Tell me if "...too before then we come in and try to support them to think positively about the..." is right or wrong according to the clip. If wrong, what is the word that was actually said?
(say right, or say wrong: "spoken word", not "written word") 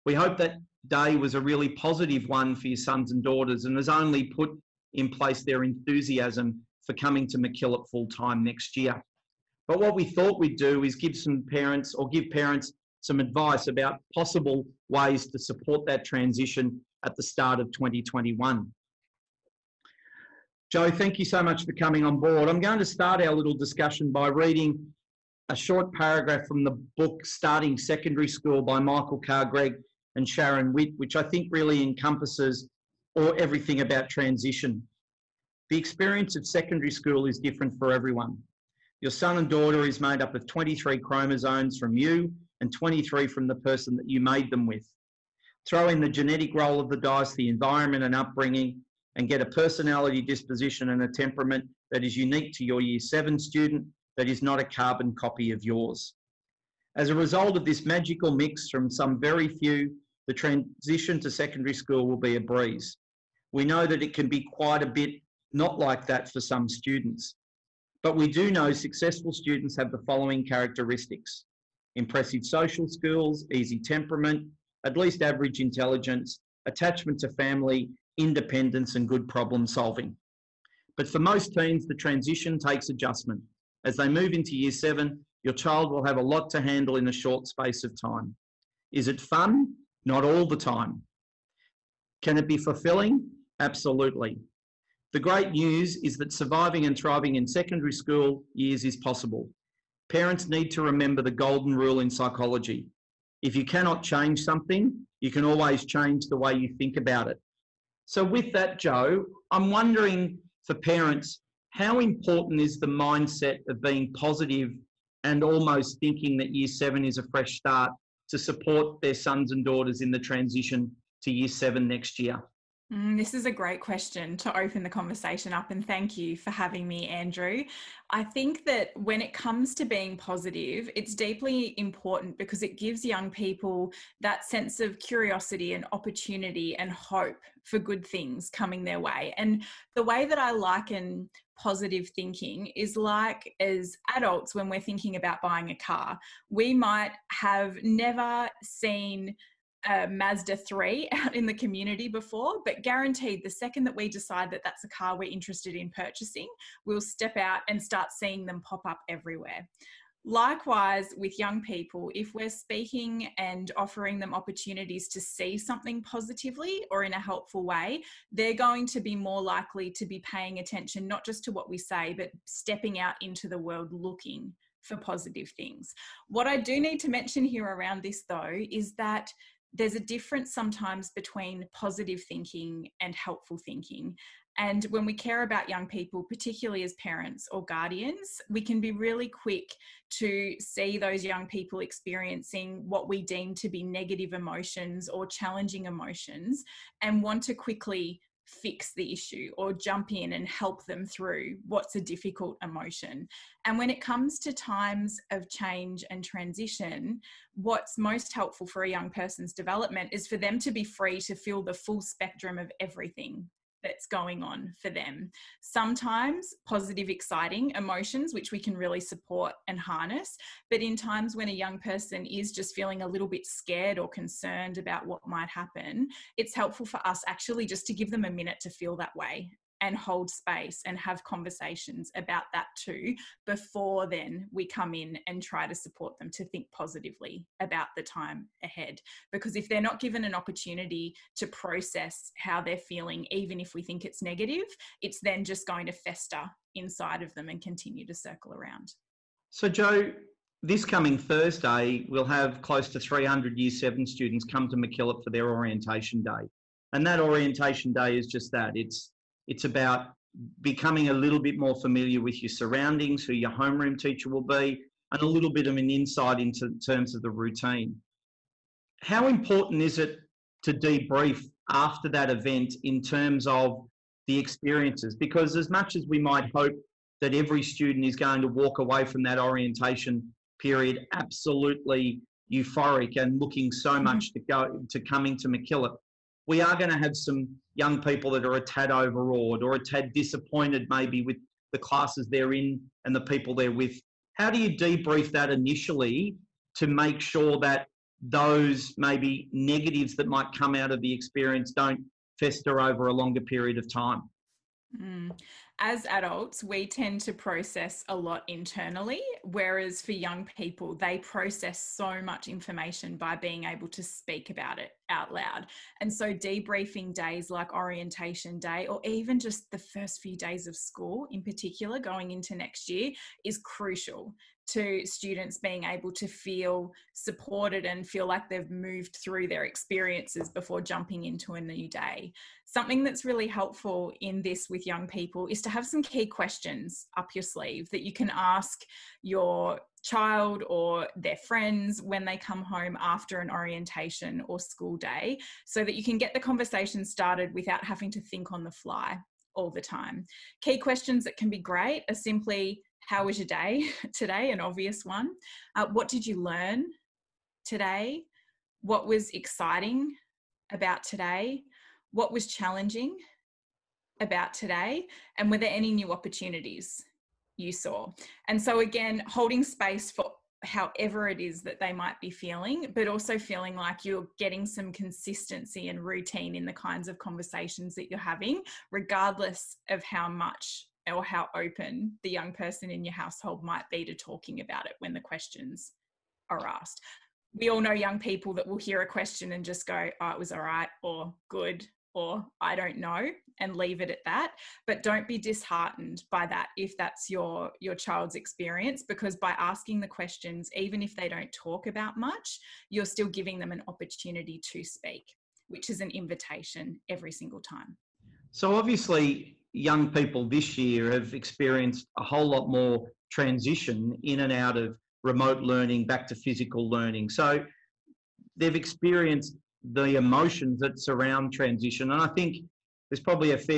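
right.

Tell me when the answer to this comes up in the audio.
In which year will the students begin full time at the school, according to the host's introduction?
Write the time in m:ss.
0:17.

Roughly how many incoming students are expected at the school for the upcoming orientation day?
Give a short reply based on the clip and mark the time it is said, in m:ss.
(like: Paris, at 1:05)
300, at 4:12.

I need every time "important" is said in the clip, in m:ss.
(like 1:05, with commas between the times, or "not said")
1:51, 2:11, 4:29.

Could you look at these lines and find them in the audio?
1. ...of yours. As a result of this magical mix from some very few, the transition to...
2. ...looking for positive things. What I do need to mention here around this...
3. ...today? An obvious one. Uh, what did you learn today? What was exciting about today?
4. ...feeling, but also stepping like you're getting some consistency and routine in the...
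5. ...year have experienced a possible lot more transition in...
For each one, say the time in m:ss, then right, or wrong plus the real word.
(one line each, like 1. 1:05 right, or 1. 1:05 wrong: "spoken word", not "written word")
1. 0:55 right
2. 2:53 right
3. 5:54 right
4. 6:12 wrong: "feeling", not "stepping"
5. 6:50 wrong: "whole", not "possible".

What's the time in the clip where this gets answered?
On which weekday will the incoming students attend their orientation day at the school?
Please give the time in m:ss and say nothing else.
4:11.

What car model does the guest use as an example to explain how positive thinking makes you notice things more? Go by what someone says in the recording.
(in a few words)
Mazda 3.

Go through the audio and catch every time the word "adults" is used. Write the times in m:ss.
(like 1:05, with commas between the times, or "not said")
2:24, 5:06.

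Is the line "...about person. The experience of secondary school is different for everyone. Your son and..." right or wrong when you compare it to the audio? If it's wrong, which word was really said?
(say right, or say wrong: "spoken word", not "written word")
wrong: "transition", not "person".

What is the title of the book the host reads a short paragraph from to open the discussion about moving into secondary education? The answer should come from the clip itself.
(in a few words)
Starting Secondary School.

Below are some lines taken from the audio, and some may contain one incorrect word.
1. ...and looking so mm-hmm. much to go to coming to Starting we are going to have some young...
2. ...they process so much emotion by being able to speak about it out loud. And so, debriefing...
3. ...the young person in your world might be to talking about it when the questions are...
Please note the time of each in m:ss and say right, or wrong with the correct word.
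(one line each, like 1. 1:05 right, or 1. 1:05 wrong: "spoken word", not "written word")
1. 4:43 wrong: "MacKillop", not "Starting"
2. 5:10 wrong: "information", not "emotion"
3. 6:22 wrong: "household", not "world".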